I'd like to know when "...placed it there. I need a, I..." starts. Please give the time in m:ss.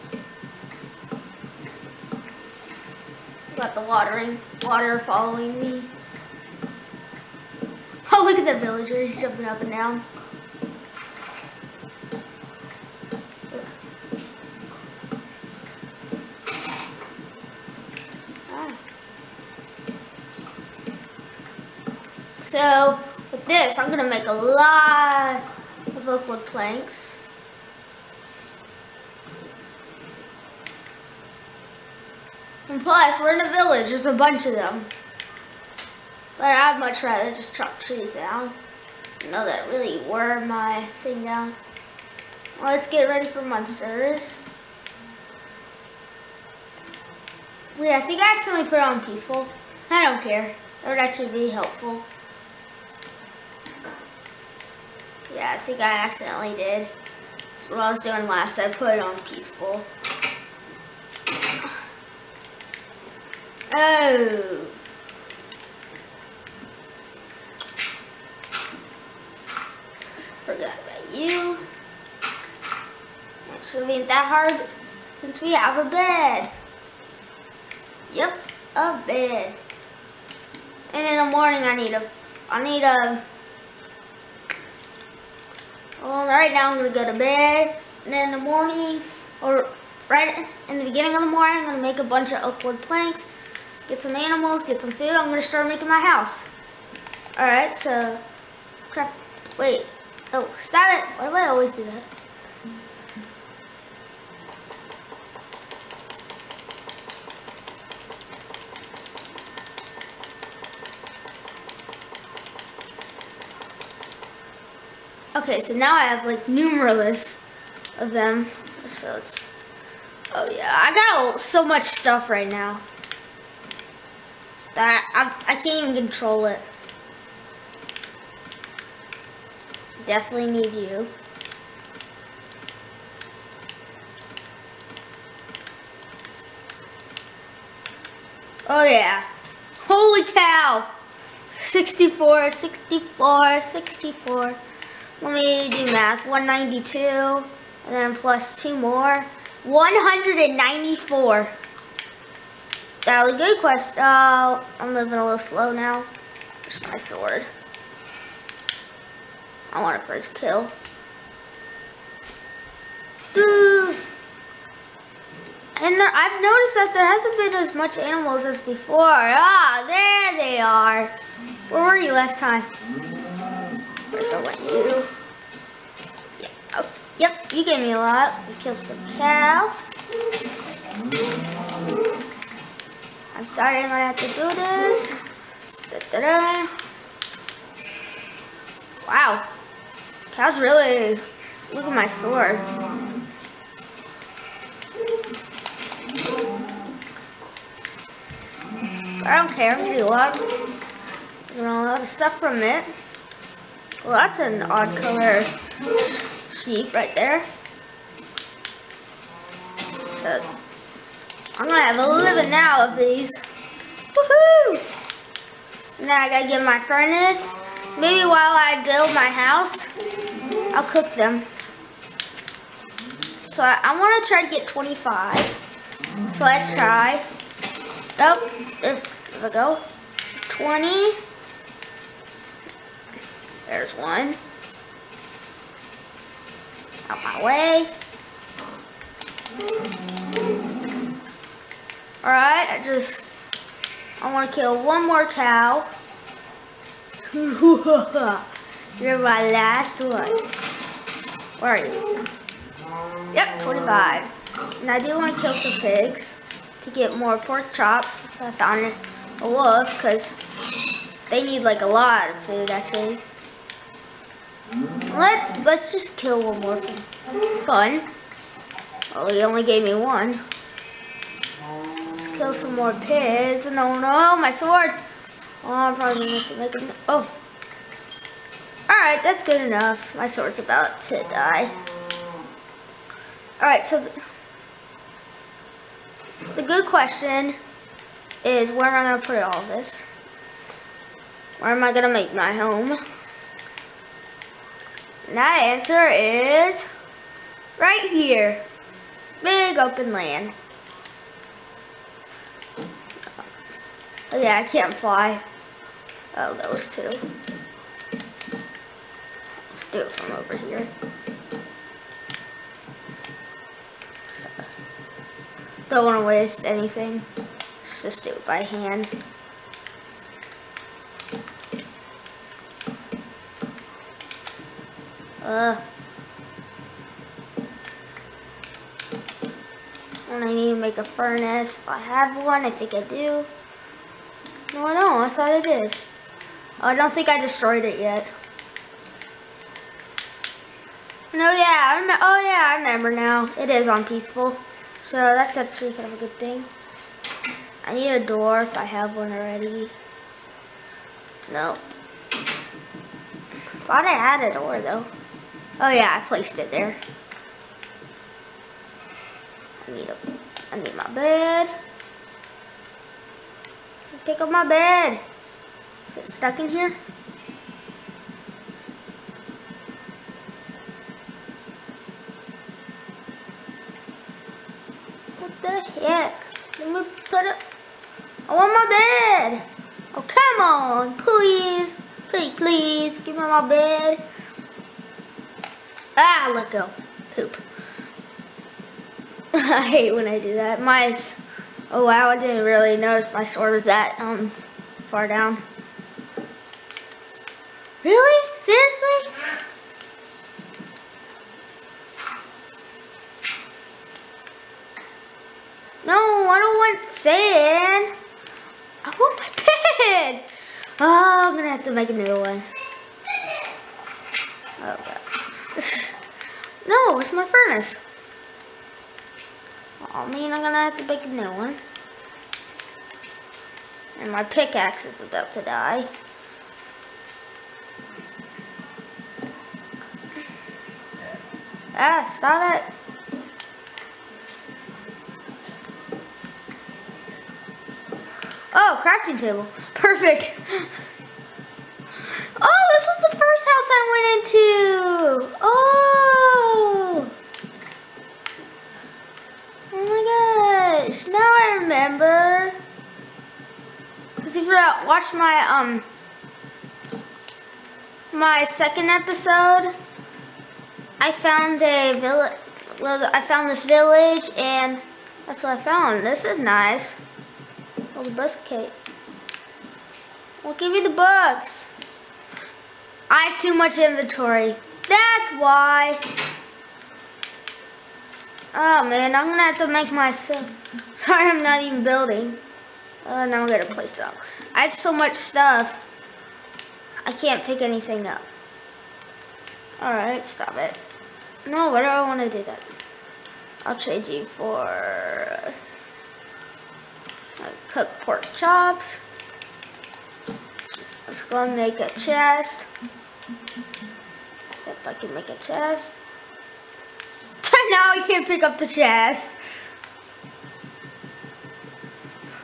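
5:56.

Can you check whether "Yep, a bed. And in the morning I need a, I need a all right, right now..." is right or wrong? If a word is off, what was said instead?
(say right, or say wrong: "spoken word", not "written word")
right.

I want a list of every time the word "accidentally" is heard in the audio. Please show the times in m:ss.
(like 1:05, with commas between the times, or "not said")
0:48, 0:56.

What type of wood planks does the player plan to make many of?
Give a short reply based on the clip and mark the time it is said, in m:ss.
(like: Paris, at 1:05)
Oak wood planks, at 0:26.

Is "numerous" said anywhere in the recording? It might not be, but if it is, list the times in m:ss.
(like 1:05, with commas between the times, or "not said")
1:56.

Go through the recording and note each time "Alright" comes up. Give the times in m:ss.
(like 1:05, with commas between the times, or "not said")
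4:02, 4:38, 4:43, 8:10.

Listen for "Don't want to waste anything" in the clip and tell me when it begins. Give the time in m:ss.
5:15.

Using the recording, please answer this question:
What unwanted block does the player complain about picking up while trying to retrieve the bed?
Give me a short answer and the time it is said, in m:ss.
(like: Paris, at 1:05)
Sand, at 6:47.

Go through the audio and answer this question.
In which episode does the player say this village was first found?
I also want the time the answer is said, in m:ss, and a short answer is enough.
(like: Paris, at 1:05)
Second episode, at 7:38.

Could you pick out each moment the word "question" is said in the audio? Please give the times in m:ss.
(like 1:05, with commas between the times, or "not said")
2:33, 4:46.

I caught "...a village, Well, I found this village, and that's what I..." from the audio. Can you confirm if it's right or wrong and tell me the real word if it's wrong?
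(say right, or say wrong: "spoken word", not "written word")
right.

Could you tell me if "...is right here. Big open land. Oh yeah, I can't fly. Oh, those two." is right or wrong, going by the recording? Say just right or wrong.
right.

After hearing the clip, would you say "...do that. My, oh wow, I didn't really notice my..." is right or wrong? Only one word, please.
right.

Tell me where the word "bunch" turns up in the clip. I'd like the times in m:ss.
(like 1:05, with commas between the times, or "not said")
0:34, 1:32.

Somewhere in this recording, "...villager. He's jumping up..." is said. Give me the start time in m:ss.
0:08.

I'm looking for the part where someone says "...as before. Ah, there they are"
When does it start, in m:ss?
2:48.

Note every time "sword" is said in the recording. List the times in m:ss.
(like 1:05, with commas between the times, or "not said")
2:36, 3:12, 4:34, 4:40, 6:33.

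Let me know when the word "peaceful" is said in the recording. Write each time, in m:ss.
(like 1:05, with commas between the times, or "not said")
0:49, 0:59, 5:44.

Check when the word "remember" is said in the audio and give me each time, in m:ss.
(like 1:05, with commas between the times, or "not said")
5:42, 7:31.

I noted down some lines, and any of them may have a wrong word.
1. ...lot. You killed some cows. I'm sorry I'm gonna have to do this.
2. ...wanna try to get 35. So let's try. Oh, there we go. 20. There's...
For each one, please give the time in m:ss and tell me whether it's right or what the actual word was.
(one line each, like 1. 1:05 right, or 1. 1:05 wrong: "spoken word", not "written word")
1. 2:57 right
2. 3:43 wrong: "25", not "35".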